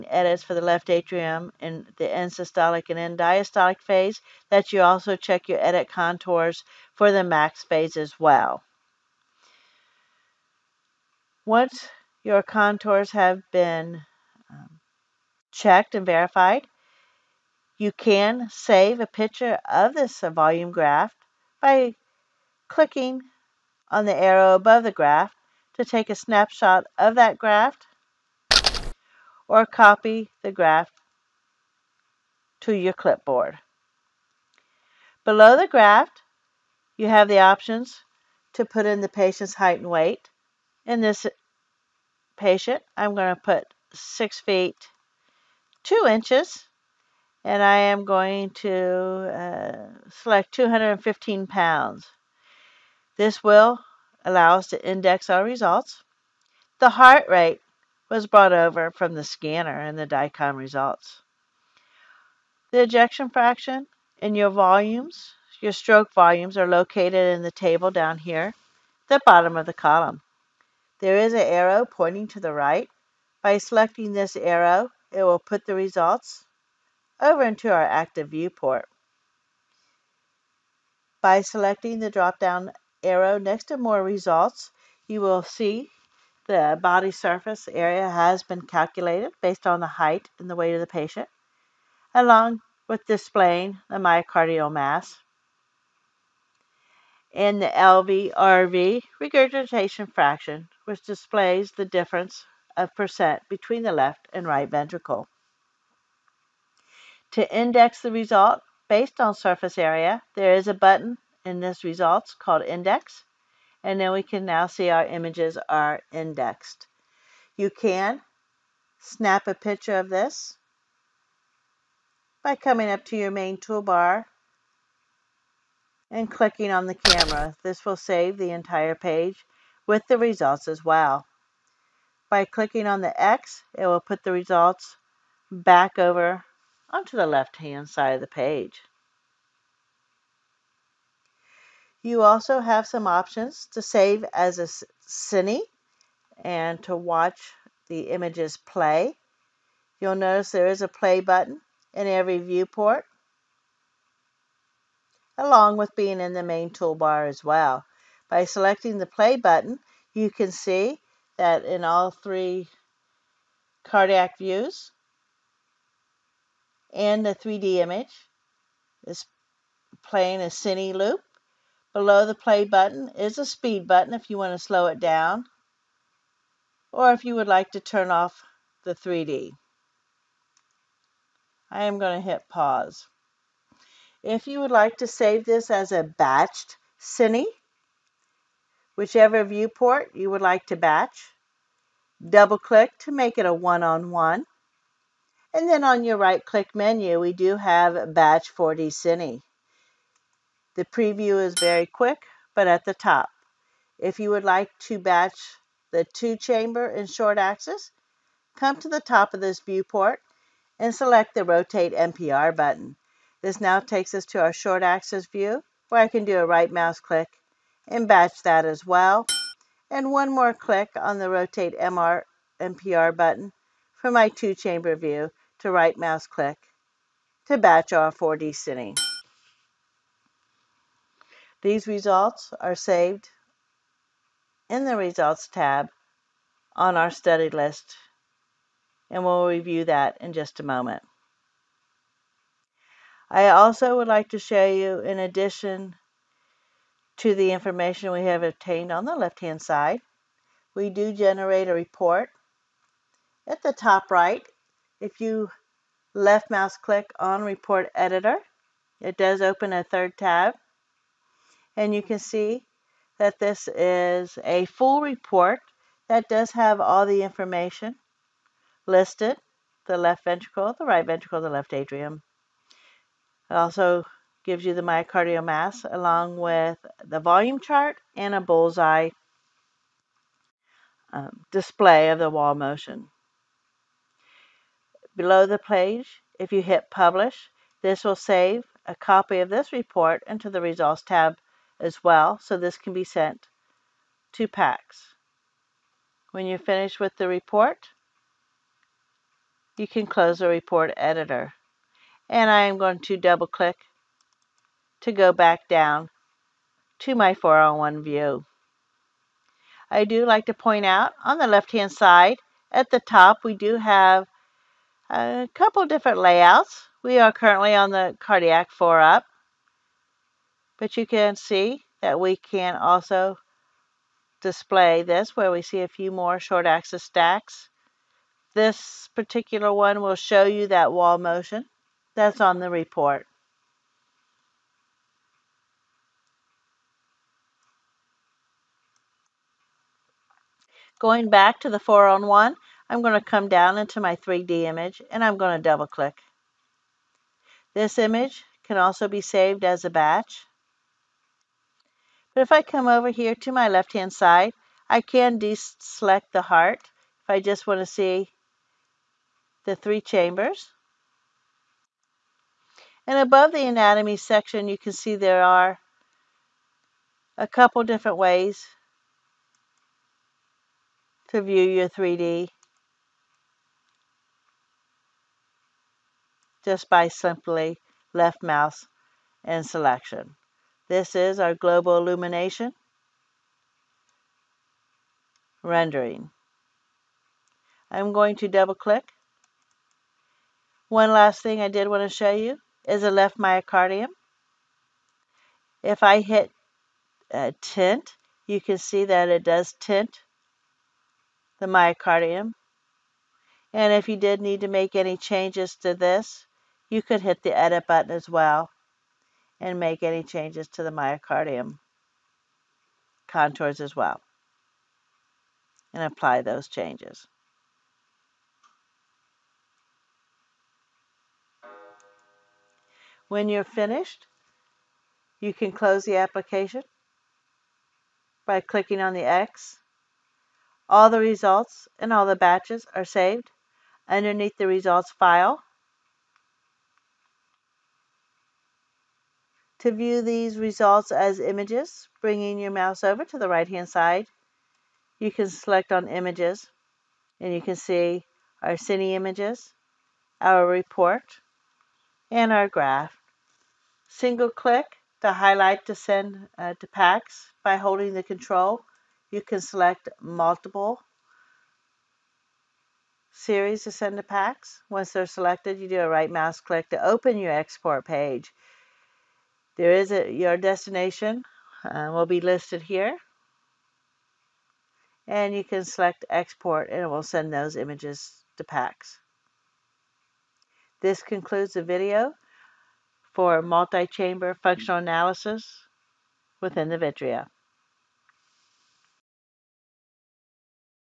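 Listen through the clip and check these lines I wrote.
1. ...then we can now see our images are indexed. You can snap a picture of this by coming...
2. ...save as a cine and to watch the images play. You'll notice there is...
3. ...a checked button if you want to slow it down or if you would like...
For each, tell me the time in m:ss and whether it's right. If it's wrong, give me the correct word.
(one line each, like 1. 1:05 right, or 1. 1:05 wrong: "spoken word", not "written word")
1. 1:53 right
2. 2:23 right
3. 2:53 wrong: "speed", not "checked".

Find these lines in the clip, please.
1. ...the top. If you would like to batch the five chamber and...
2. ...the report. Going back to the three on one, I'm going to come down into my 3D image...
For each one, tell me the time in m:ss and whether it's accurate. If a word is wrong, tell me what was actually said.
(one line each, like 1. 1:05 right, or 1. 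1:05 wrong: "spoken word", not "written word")
1. 3:22 wrong: "two", not "five"
2. 5:32 wrong: "four", not "three".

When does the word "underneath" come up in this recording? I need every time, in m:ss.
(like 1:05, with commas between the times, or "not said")
7:14.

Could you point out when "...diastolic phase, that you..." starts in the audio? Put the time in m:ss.
0:03.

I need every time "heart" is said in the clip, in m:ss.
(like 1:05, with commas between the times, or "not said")
0:56, 5:56.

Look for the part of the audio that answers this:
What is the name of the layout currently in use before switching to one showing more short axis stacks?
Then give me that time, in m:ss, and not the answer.
5:18.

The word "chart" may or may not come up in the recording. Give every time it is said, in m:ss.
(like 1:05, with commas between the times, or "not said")
4:37.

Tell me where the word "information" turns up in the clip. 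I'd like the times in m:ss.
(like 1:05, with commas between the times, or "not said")
4:07, 4:27.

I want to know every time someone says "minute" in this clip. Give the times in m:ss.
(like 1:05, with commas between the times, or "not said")
not said.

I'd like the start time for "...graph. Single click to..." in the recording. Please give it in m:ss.
7:32.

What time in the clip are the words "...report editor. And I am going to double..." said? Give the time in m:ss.
5:00.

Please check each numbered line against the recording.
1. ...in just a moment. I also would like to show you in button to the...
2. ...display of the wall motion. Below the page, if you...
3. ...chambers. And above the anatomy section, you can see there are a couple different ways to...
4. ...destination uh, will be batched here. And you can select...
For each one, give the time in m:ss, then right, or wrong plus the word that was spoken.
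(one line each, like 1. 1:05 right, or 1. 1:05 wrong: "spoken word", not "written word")
1. 4:00 wrong: "addition", not "button"
2. 4:41 right
3. 5:59 right
4. 7:50 wrong: "listed", not "batched".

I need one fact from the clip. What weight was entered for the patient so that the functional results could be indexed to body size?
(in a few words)
215 pounds.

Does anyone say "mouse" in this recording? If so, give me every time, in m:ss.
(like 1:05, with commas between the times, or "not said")
3:36, 3:45, 4:16, 6:18, 7:22, 7:46.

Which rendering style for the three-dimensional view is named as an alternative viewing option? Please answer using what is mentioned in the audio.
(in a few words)
global illumination.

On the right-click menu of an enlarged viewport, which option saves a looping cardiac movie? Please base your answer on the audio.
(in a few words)
Batch 4D Cine.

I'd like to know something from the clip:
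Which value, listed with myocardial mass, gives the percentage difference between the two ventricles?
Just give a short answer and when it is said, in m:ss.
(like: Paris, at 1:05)
LVRV regurgitation fraction, at 1:37.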